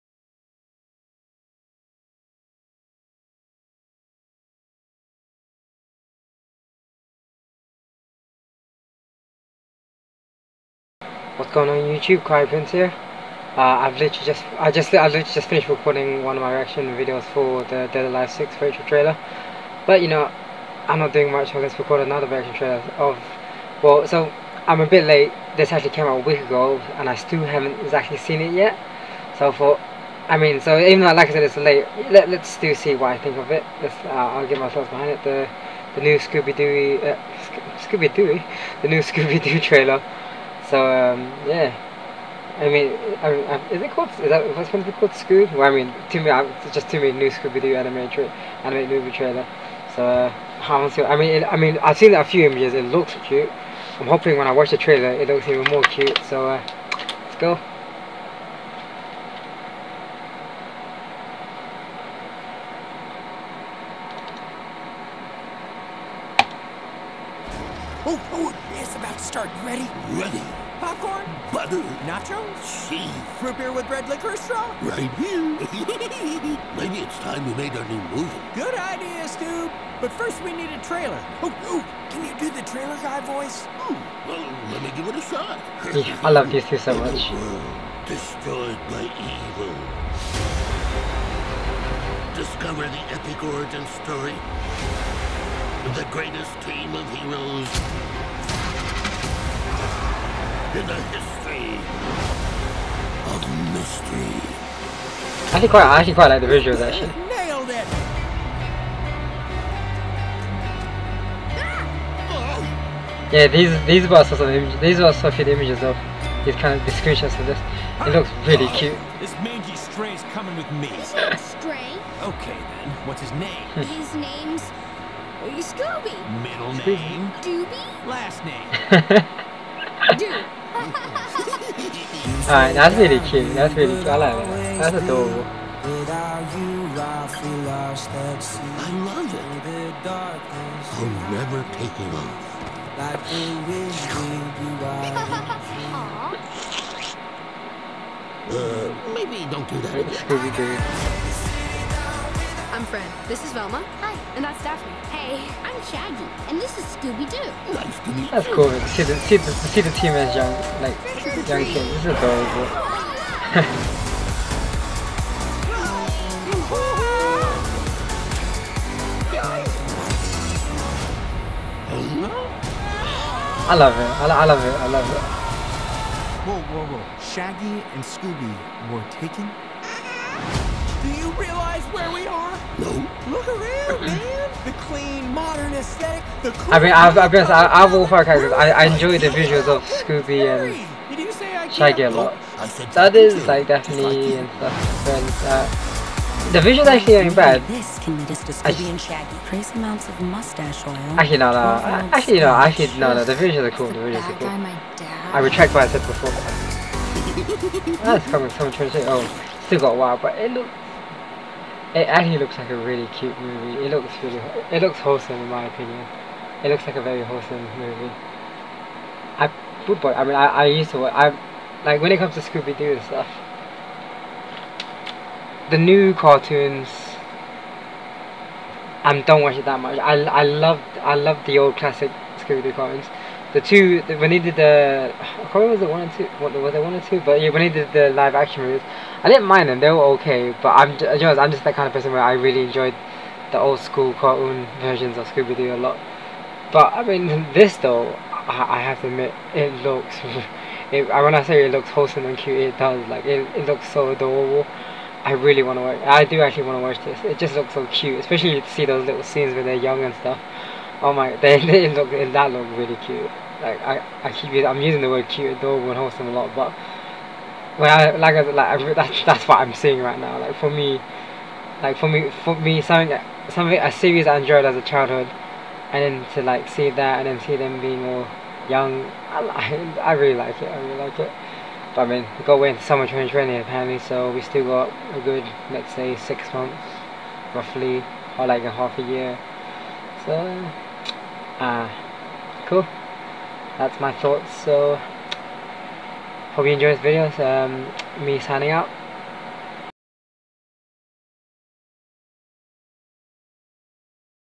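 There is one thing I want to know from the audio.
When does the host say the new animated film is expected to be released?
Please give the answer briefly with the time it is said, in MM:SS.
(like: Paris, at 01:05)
summer 2020, at 04:42.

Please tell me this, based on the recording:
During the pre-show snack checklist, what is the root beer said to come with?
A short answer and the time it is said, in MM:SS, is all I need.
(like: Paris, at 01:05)
red liquor straw, at 01:13.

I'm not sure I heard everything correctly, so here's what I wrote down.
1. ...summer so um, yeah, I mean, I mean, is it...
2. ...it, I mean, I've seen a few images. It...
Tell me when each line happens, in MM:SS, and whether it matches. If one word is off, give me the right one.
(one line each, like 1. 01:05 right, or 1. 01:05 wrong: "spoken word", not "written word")
1. 00:39 wrong: "trailer", not "summer"
2. 00:51 right.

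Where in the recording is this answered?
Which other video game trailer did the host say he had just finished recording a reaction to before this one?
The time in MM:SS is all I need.
00:17.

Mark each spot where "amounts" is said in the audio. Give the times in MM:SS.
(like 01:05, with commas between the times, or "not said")
03:19.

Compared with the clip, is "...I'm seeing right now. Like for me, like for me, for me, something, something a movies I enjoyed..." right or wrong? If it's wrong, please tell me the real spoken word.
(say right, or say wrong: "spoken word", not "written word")
wrong: "series", not "movies".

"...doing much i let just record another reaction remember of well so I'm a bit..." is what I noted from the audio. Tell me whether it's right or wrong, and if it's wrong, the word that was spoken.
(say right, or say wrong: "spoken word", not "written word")
wrong: "trailer", not "remember".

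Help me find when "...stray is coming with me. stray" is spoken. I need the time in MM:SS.
01:59.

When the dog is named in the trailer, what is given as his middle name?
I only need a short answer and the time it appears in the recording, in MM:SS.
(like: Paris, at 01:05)
Doobie, at 02:07.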